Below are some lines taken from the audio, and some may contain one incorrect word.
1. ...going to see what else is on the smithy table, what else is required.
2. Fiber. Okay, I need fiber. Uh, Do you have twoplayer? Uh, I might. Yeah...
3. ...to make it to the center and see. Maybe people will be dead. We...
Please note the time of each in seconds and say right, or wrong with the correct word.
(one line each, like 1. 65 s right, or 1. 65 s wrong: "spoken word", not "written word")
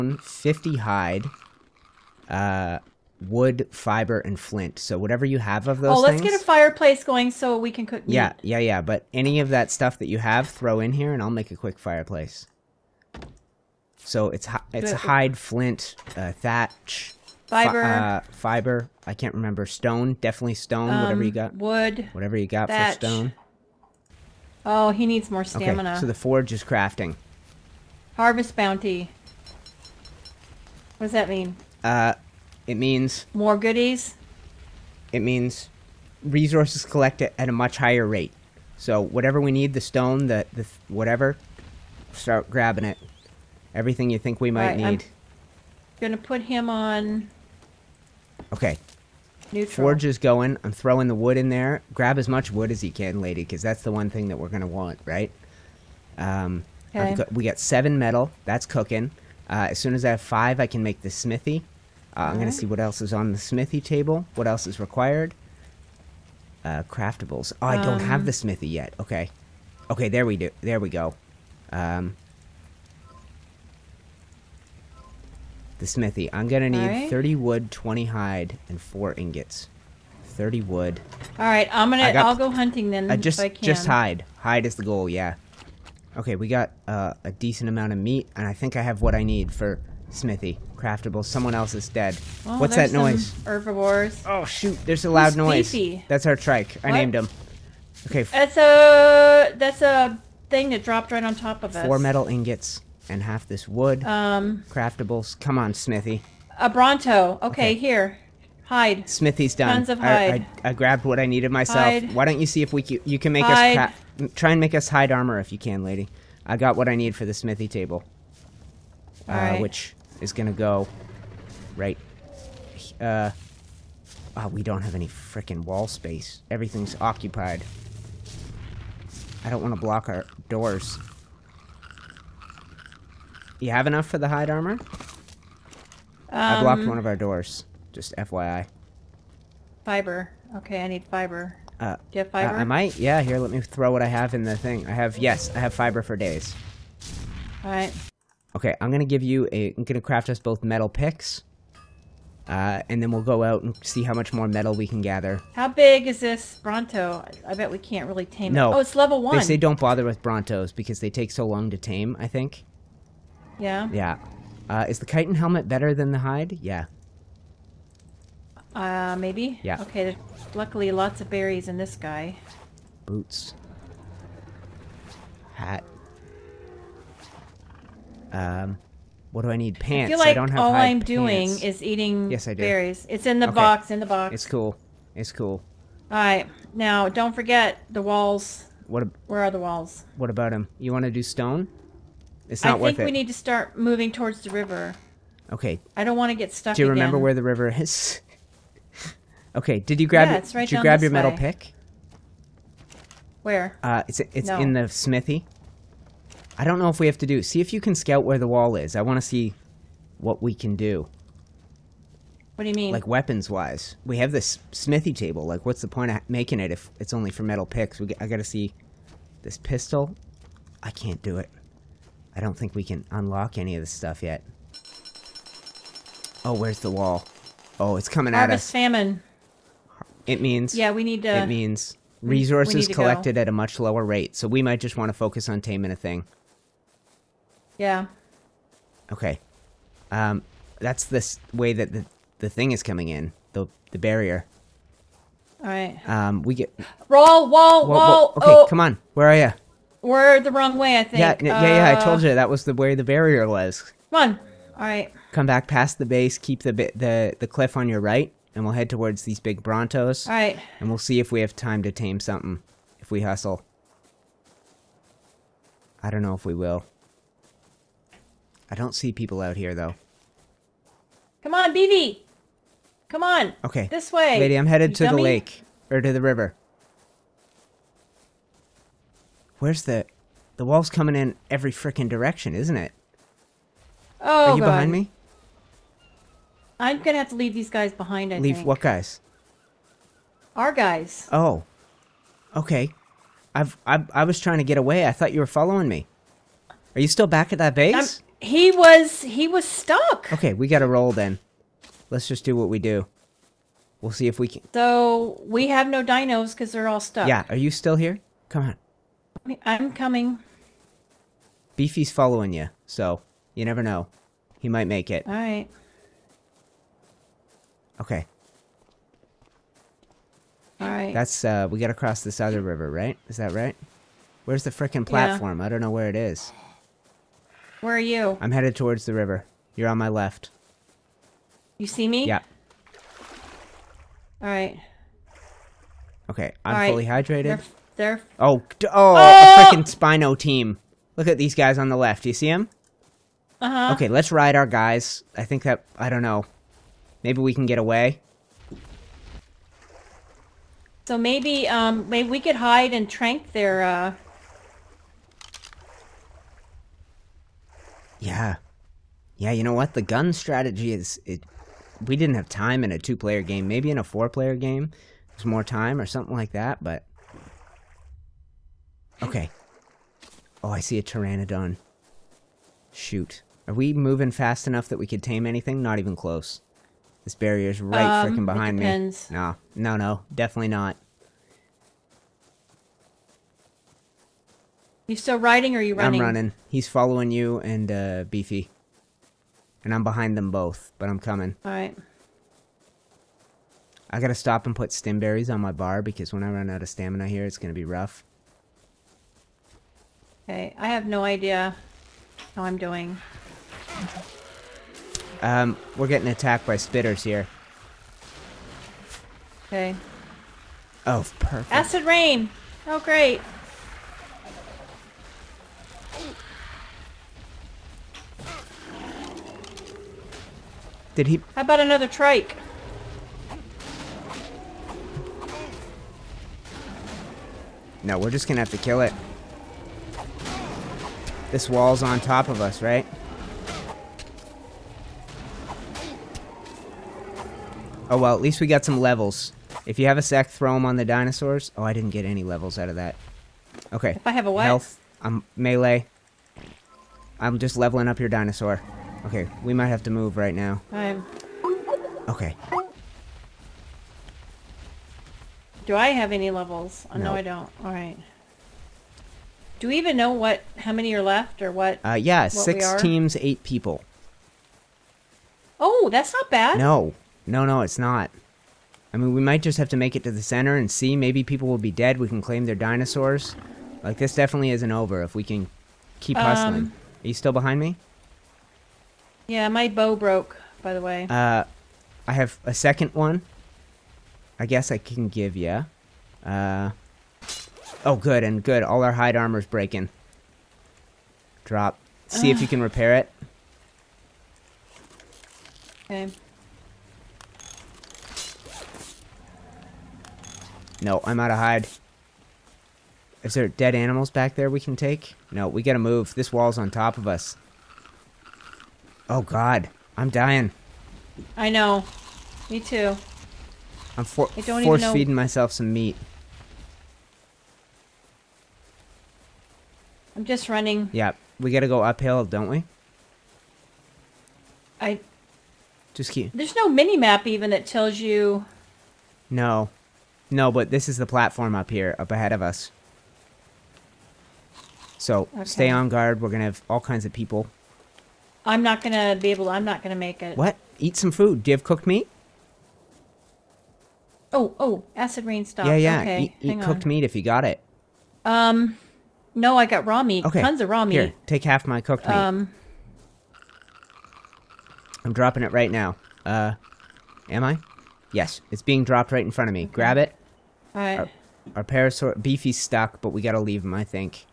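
1. 62 s right
2. 139 s wrong: "fiber", not "twoplayer"
3. 469 s right.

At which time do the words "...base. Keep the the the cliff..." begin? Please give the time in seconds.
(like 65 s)
256 s.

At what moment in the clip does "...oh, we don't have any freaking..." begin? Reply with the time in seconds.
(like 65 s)
124 s.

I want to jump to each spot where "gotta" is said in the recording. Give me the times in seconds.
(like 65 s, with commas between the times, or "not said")
218 s, 394 s, 505 s, 521 s, 563 s.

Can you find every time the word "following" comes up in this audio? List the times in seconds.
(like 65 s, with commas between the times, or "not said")
295 s, 312 s, 386 s.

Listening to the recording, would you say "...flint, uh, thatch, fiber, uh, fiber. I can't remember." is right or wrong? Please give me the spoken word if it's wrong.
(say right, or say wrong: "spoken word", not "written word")
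right.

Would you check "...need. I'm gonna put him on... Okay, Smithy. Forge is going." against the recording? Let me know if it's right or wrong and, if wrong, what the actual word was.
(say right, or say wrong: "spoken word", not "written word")
wrong: "Neutral", not "Smithy".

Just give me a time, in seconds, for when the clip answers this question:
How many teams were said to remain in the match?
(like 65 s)
462 s.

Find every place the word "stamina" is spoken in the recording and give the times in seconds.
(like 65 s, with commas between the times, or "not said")
25 s, 396 s.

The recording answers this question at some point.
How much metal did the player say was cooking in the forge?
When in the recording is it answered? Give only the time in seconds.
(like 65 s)
57 s.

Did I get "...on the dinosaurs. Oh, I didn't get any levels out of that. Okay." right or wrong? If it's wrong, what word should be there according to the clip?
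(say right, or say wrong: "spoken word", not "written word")
right.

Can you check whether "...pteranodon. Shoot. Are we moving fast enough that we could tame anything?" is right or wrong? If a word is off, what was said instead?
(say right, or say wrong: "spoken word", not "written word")
right.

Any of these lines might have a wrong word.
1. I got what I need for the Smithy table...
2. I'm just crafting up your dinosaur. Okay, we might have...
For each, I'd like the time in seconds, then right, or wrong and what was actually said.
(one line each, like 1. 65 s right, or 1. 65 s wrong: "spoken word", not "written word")
1. 116 s right
2. 447 s wrong: "leveling", not "crafting".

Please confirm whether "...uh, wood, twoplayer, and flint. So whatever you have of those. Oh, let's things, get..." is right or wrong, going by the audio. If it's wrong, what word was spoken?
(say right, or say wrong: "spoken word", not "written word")
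wrong: "fiber", not "twoplayer".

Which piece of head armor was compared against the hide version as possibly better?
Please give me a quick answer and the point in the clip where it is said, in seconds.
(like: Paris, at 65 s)
chitin helmet, at 165 s.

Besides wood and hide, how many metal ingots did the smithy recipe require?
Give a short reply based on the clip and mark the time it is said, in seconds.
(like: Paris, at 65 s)
4, at 78 s.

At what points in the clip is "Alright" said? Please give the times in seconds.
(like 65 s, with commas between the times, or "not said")
147 s, 186 s, 391 s.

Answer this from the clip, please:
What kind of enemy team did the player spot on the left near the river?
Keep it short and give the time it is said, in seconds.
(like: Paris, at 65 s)
Spino team, at 339 s.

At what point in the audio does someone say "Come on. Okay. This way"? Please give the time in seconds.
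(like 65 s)
273 s.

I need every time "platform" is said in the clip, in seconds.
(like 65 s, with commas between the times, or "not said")
325 s, 531 s.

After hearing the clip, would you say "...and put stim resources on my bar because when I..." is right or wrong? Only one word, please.
wrong.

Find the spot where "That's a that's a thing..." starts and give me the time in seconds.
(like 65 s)
98 s.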